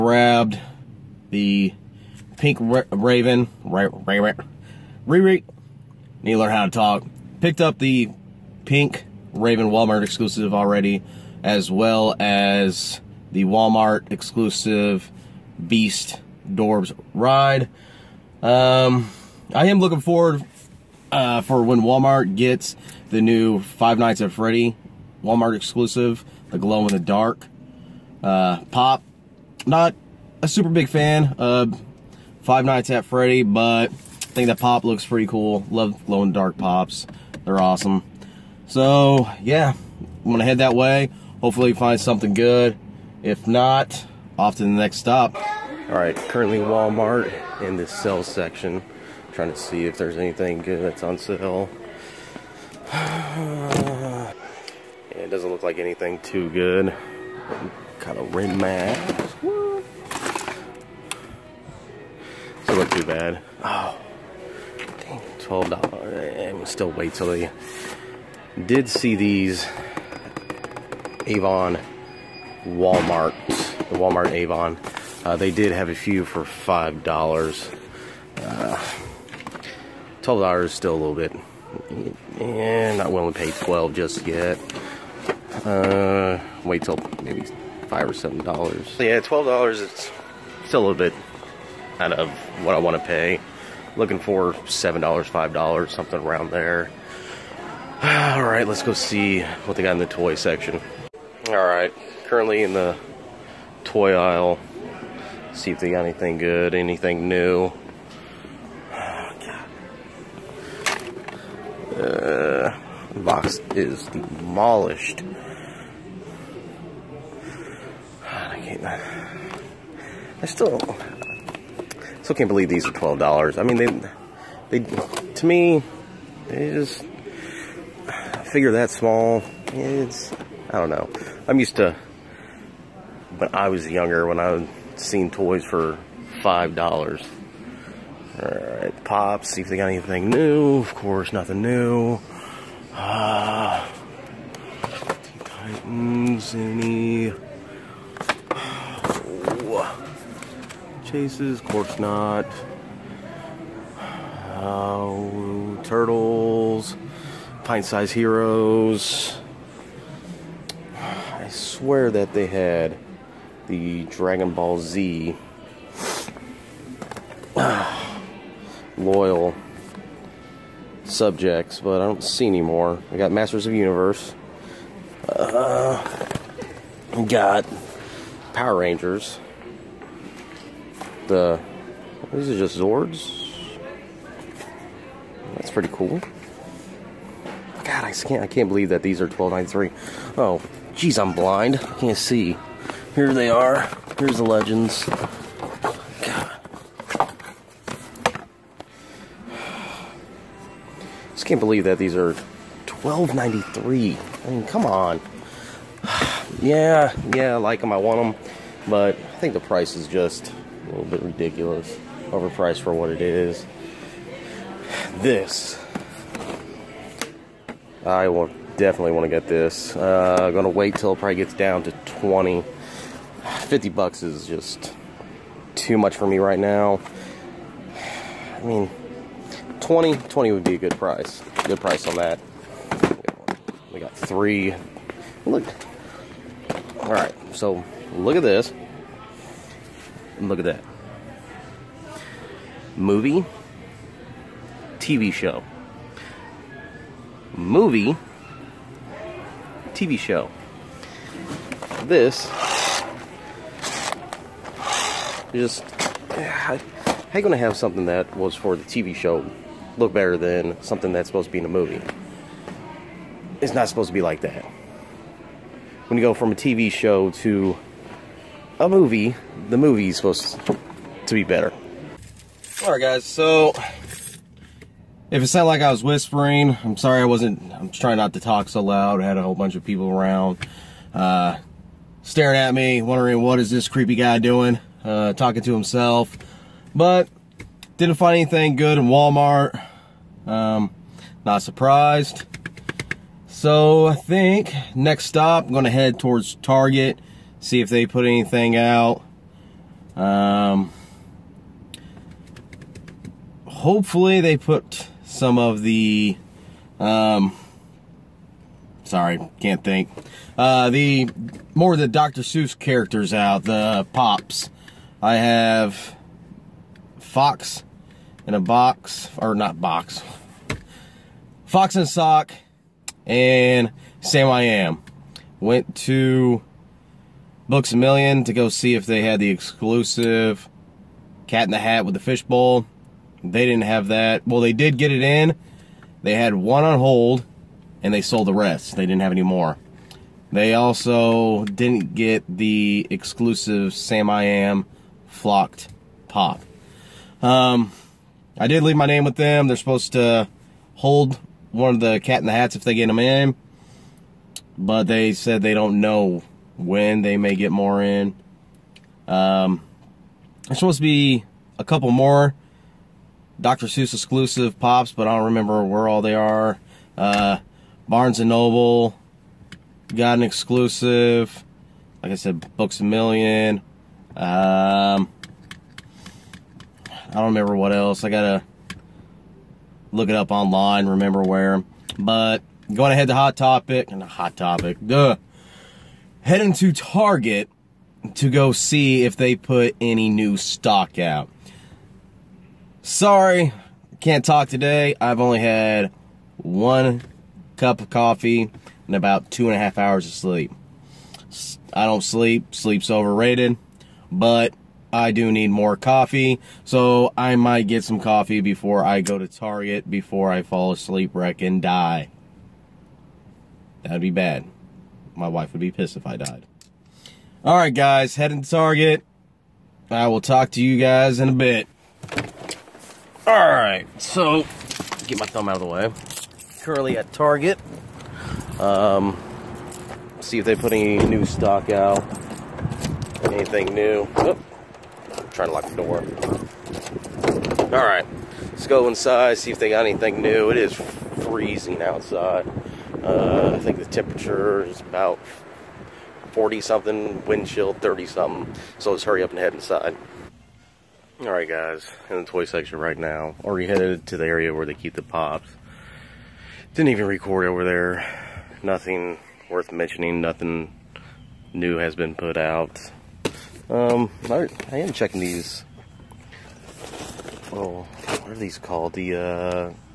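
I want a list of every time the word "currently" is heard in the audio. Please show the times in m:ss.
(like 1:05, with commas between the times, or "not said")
0:46, 1:42, 7:06.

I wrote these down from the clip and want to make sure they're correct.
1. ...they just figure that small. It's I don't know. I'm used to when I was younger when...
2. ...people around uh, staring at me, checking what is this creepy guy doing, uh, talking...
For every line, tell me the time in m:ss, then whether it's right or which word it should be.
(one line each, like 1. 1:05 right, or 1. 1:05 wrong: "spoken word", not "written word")
1. 2:06 right
2. 4:39 wrong: "wondering", not "checking".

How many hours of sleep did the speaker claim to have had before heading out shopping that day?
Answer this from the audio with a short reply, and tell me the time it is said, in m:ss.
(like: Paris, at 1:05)
2.5 hours, at 6:39.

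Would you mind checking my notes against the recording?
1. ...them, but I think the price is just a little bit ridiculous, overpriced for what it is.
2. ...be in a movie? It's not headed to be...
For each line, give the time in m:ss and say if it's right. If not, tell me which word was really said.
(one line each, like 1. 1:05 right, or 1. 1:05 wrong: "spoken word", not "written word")
1. 3:28 right
2. 4:21 wrong: "supposed", not "headed".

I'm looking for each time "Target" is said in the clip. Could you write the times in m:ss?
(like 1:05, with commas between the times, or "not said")
4:56, 6:26, 6:49, 6:58, 7:07.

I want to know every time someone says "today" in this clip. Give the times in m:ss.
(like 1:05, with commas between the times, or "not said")
6:34.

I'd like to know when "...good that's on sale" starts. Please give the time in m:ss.
0:50.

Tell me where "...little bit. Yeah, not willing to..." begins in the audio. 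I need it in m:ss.
1:20.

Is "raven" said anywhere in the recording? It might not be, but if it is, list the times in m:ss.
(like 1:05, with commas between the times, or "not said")
0:02, 0:09.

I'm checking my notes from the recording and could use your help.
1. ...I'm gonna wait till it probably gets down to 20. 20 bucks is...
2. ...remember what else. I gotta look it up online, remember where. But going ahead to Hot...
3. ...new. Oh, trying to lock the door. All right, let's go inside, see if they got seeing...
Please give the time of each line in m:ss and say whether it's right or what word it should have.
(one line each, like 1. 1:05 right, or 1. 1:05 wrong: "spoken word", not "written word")
1. 3:40 wrong: "50", not "20"
2. 6:17 right
3. 7:13 wrong: "anything", not "seeing".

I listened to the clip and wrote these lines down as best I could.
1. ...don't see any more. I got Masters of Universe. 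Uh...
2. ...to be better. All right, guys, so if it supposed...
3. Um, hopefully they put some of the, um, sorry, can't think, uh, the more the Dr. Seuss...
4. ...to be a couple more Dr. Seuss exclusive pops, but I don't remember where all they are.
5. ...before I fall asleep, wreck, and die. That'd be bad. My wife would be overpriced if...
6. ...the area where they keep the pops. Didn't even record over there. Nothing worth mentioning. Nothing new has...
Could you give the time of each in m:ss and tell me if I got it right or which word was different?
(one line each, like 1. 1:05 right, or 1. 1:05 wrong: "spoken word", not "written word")
1. 2:52 right
2. 4:31 wrong: "sounded", not "supposed"
3. 5:00 right
4. 6:00 right
5. 6:50 wrong: "pissed", not "overpriced"
6. 7:34 right.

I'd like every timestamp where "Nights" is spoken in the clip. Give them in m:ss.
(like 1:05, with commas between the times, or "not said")
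0:23, 0:32.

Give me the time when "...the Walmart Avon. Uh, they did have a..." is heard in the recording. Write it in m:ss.
1:13.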